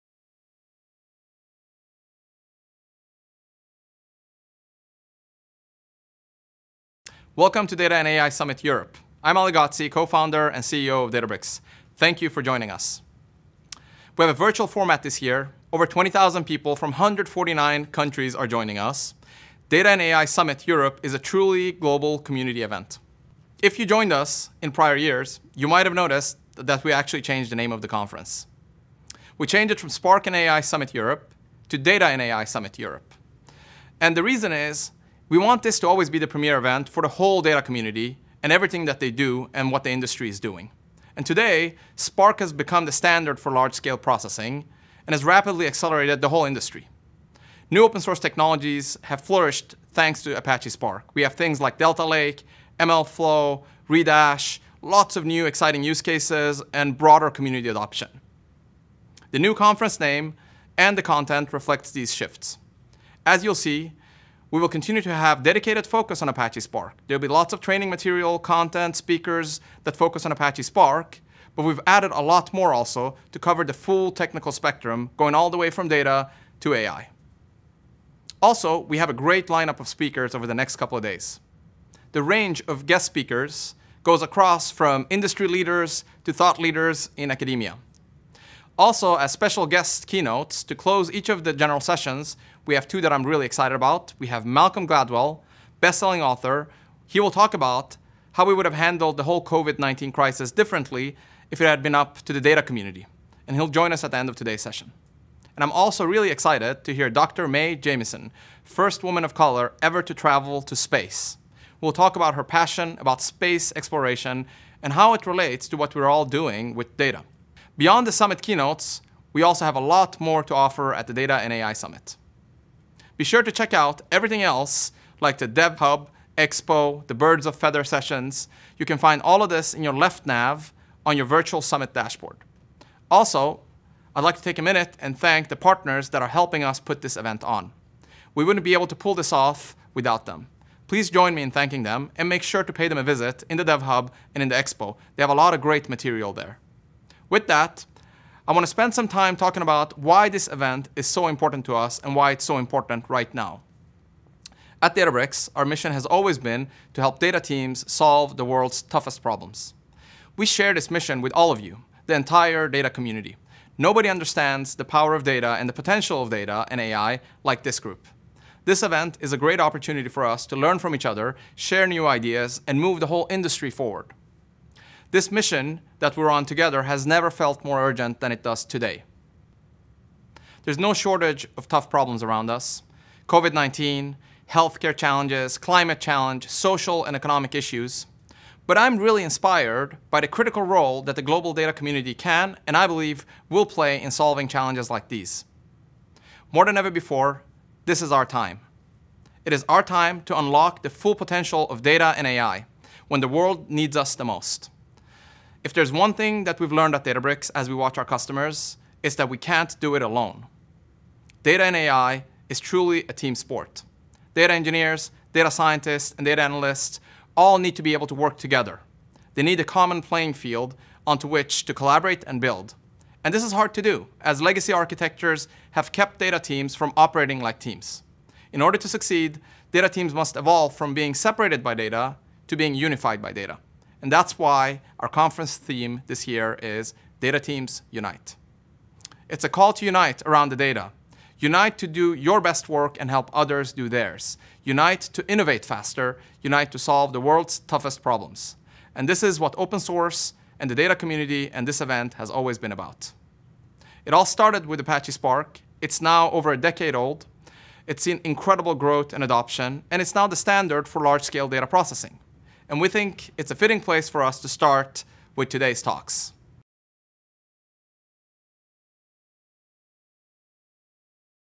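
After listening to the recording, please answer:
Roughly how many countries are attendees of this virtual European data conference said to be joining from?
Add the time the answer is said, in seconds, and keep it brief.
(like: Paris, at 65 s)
149, at 16 s.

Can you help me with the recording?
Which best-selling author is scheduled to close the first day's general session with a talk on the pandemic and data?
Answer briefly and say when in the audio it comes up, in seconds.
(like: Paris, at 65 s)
Malcolm Gladwell, at 94 s.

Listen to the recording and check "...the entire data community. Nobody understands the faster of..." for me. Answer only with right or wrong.
wrong.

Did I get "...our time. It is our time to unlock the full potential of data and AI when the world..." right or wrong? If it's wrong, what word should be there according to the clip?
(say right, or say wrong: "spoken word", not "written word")
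right.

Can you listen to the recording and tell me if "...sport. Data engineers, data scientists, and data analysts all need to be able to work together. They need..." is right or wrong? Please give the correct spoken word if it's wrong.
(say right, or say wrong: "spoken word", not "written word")
right.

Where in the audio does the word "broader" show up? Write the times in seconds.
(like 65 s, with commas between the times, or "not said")
56 s.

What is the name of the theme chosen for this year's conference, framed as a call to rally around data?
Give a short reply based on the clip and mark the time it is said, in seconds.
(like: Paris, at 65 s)
Data Teams Unite, at 237 s.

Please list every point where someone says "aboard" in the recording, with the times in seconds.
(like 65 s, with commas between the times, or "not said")
not said.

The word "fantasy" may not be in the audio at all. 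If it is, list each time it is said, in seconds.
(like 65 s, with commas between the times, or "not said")
not said.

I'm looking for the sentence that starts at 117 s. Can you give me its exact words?
Beyond the summit keynotes, we also have a lot more to offer at the Data and AI Summit.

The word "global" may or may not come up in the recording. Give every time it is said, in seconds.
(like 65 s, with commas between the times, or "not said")
21 s, 191 s.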